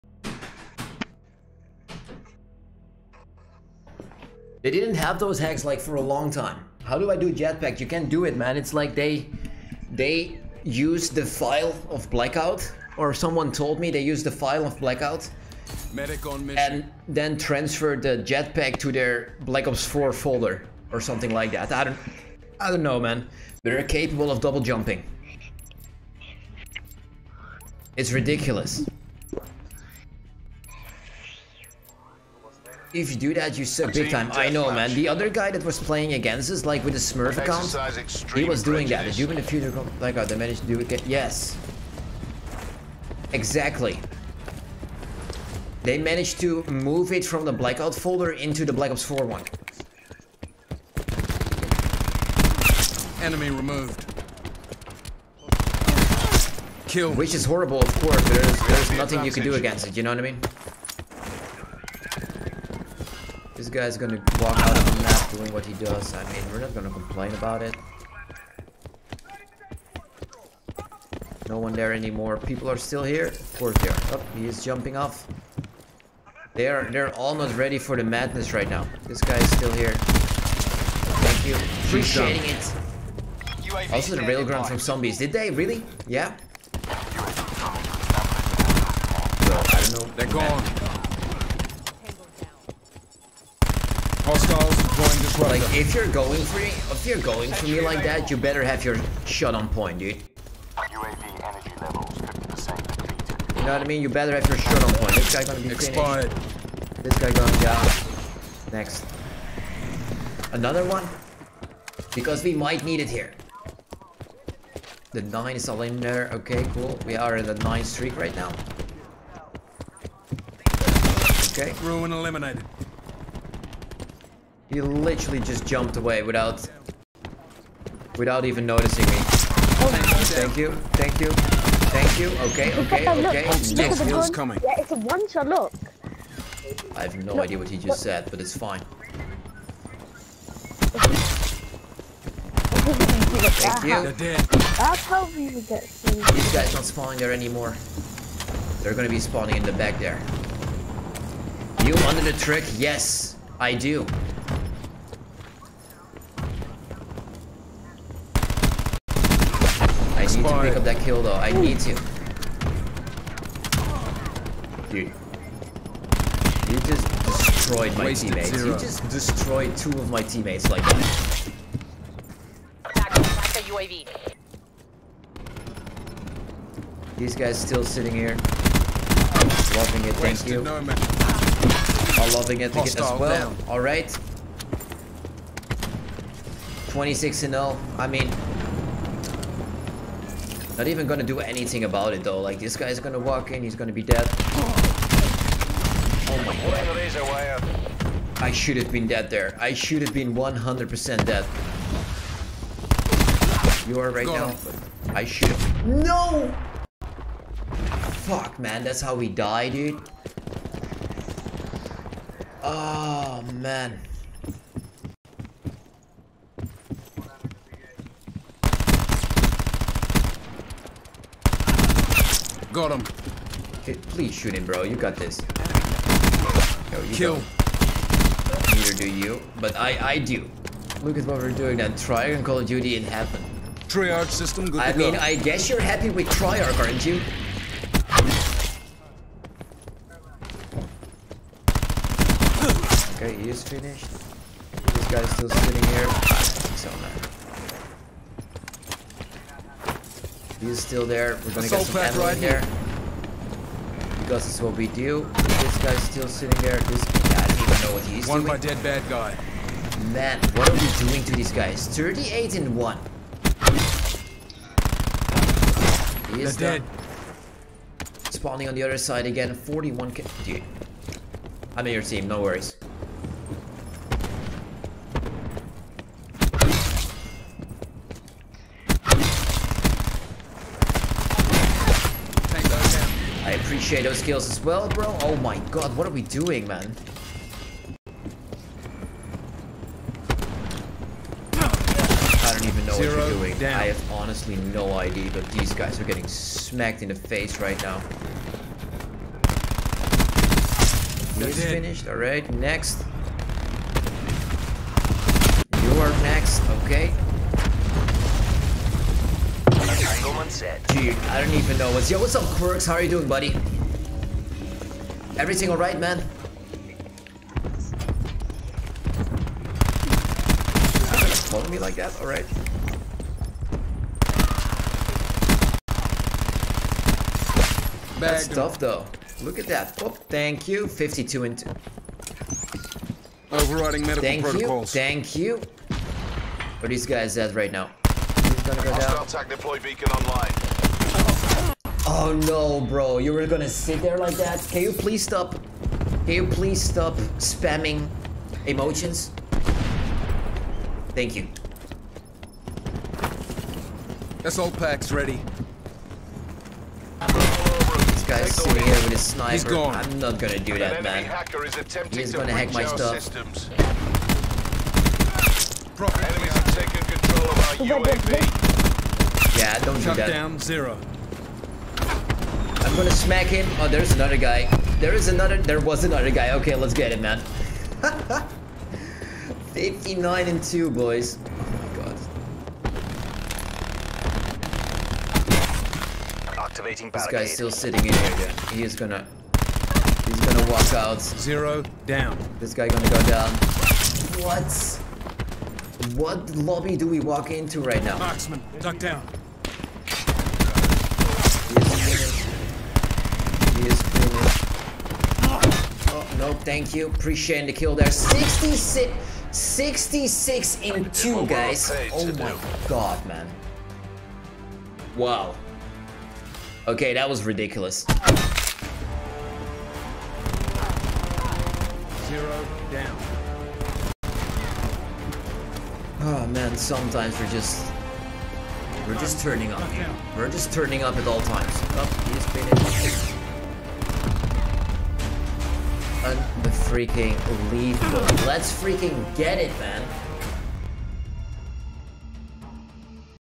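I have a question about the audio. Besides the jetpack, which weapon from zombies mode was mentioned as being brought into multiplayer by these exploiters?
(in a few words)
railgun.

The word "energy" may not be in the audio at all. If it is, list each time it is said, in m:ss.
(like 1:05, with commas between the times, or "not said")
1:41.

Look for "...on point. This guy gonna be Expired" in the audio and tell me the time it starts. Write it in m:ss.
1:44.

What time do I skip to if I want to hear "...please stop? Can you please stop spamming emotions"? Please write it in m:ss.
5:44.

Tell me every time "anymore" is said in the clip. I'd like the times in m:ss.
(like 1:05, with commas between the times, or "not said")
1:11, 2:27.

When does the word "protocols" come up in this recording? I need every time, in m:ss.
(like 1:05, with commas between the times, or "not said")
5:34.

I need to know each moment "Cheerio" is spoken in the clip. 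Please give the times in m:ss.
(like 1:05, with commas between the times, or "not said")
not said.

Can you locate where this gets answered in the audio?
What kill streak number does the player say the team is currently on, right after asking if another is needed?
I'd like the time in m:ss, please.
1:57.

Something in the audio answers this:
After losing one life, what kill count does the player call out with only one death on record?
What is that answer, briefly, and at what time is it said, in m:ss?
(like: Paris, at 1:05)
38, at 4:21.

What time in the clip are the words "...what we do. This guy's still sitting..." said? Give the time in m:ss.
4:14.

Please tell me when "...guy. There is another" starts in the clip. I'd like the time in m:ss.
6:14.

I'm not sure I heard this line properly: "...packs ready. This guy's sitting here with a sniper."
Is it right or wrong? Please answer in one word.
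right.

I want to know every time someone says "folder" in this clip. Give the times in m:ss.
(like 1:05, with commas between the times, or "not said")
0:20, 0:47.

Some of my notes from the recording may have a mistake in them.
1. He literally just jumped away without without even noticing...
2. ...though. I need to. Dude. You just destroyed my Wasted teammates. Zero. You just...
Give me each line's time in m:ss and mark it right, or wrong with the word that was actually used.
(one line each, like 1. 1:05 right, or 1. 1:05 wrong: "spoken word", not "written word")
1. 2:04 right
2. 2:41 right.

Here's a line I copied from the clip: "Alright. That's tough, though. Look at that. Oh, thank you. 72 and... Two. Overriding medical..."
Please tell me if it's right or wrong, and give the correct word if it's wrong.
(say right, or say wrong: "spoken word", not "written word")
wrong: "52", not "72".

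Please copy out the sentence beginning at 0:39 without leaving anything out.
The human in the future, like, oh, they managed to do it.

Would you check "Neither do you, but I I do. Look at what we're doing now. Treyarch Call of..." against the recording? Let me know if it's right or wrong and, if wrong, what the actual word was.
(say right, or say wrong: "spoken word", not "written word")
right.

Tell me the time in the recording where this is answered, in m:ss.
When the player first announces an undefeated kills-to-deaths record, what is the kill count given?
3:06.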